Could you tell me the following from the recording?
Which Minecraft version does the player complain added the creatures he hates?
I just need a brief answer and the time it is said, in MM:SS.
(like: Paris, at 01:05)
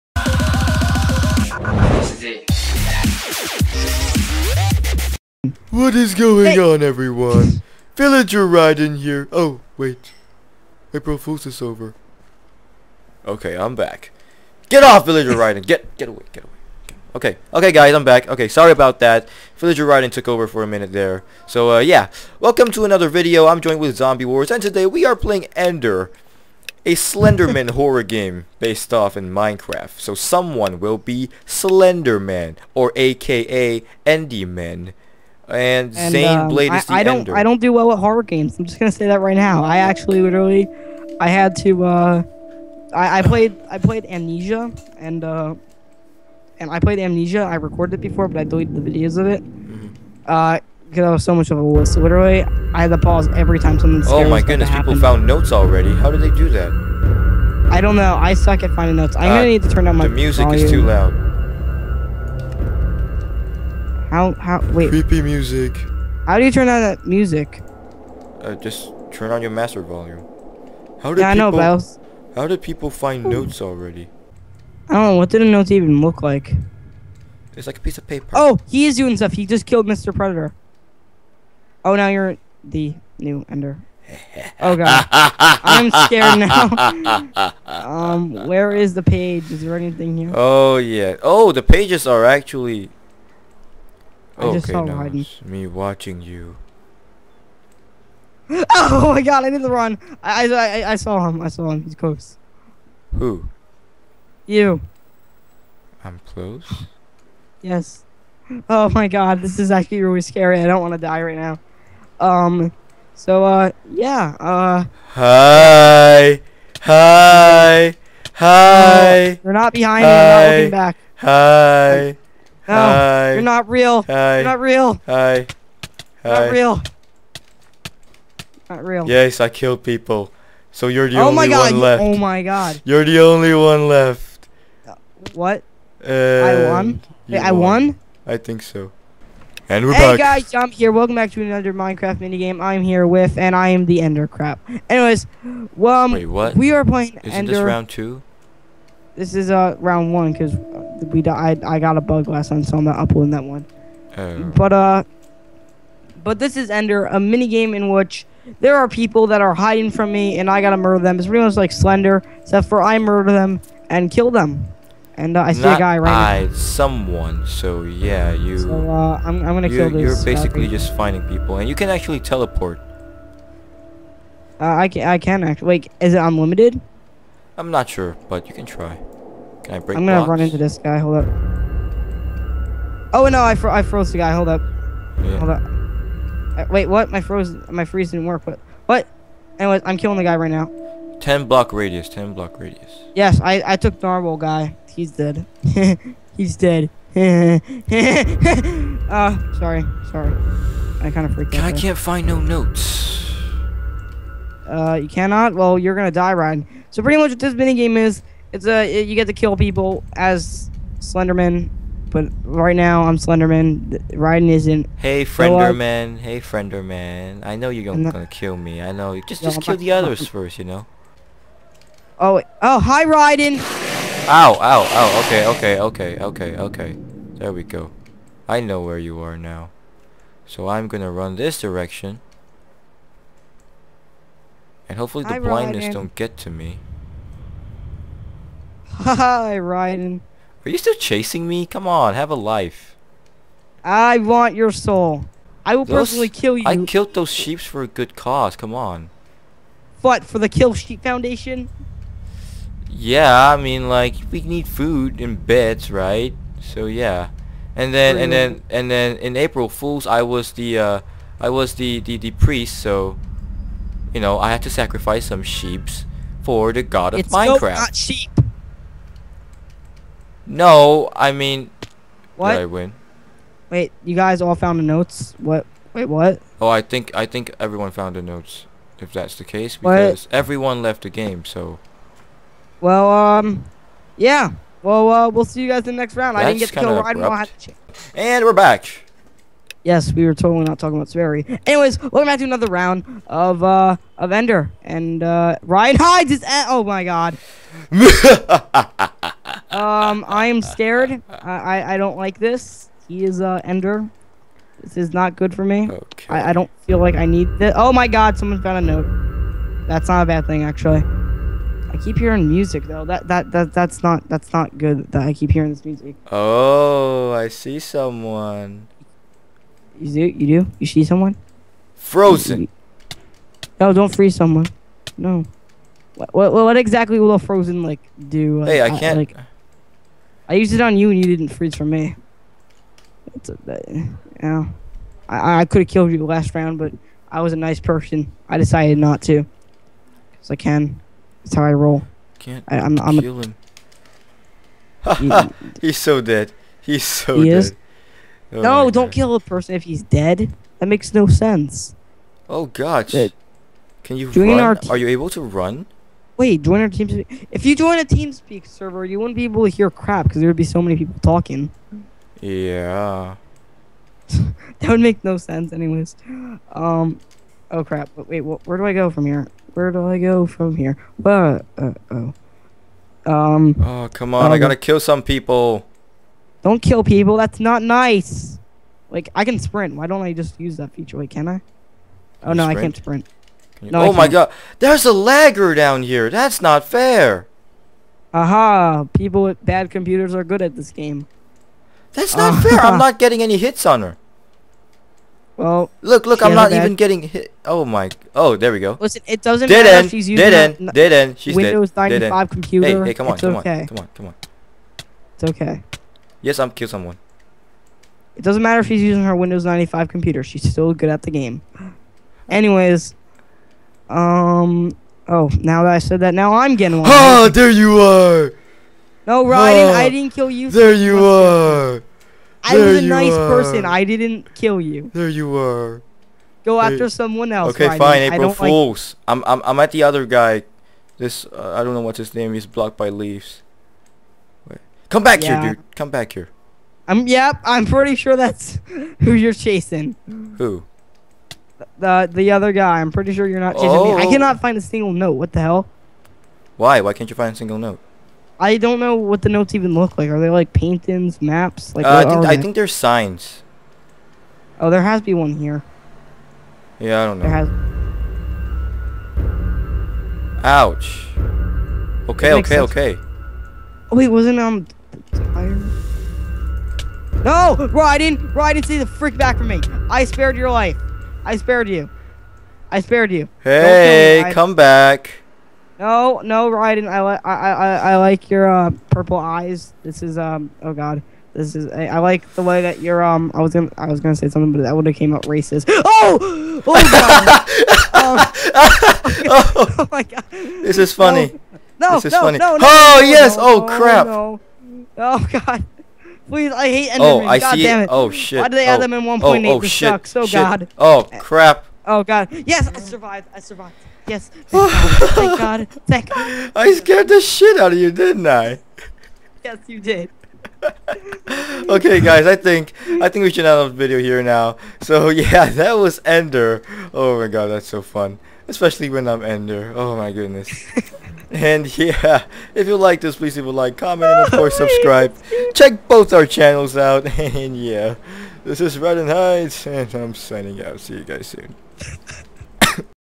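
1.8, at 08:19.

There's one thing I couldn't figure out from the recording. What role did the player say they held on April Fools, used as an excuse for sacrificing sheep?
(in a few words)
priest.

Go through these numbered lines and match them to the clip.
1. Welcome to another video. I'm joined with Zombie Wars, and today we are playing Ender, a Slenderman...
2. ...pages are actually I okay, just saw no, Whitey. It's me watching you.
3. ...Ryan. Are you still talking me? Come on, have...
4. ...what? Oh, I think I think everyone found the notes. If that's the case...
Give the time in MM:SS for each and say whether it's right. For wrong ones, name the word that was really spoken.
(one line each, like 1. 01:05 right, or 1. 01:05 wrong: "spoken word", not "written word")
1. 00:22 right
2. 01:31 right
3. 03:59 wrong: "chasing", not "talking"
4. 04:36 right.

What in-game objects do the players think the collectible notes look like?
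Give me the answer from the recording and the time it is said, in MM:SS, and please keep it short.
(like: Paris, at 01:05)
signs, at 07:32.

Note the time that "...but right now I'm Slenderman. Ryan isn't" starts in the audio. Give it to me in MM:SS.
03:32.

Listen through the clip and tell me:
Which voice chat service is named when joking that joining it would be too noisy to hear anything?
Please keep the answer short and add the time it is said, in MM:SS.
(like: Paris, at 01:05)
TeamSpeak, at 05:58.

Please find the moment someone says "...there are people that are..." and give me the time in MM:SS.
02:38.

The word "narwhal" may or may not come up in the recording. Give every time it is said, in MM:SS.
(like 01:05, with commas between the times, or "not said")
03:14.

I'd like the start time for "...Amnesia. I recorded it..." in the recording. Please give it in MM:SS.
00:46.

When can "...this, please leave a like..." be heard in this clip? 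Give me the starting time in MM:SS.
08:43.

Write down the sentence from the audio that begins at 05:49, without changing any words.
kill a person if he's dead.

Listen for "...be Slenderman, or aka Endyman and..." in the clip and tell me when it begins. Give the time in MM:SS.
00:30.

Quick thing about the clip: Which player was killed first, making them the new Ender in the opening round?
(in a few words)
Mr. Predator.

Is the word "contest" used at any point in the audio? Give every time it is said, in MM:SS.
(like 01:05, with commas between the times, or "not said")
not said.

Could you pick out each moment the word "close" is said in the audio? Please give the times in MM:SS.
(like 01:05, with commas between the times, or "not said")
01:41, 01:46.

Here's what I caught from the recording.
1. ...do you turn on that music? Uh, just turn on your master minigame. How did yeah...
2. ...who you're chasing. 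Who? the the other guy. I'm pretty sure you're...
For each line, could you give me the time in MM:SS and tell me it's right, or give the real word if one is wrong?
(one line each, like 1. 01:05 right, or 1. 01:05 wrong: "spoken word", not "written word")
1. 01:06 wrong: "volume", not "minigame"
2. 07:19 right.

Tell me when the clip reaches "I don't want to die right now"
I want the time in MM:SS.
01:50.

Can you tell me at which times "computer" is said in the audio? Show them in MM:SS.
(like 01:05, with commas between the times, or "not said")
06:29, 06:42, 06:50.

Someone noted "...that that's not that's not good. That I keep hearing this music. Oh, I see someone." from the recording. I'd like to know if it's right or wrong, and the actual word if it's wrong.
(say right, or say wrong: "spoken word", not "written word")
right.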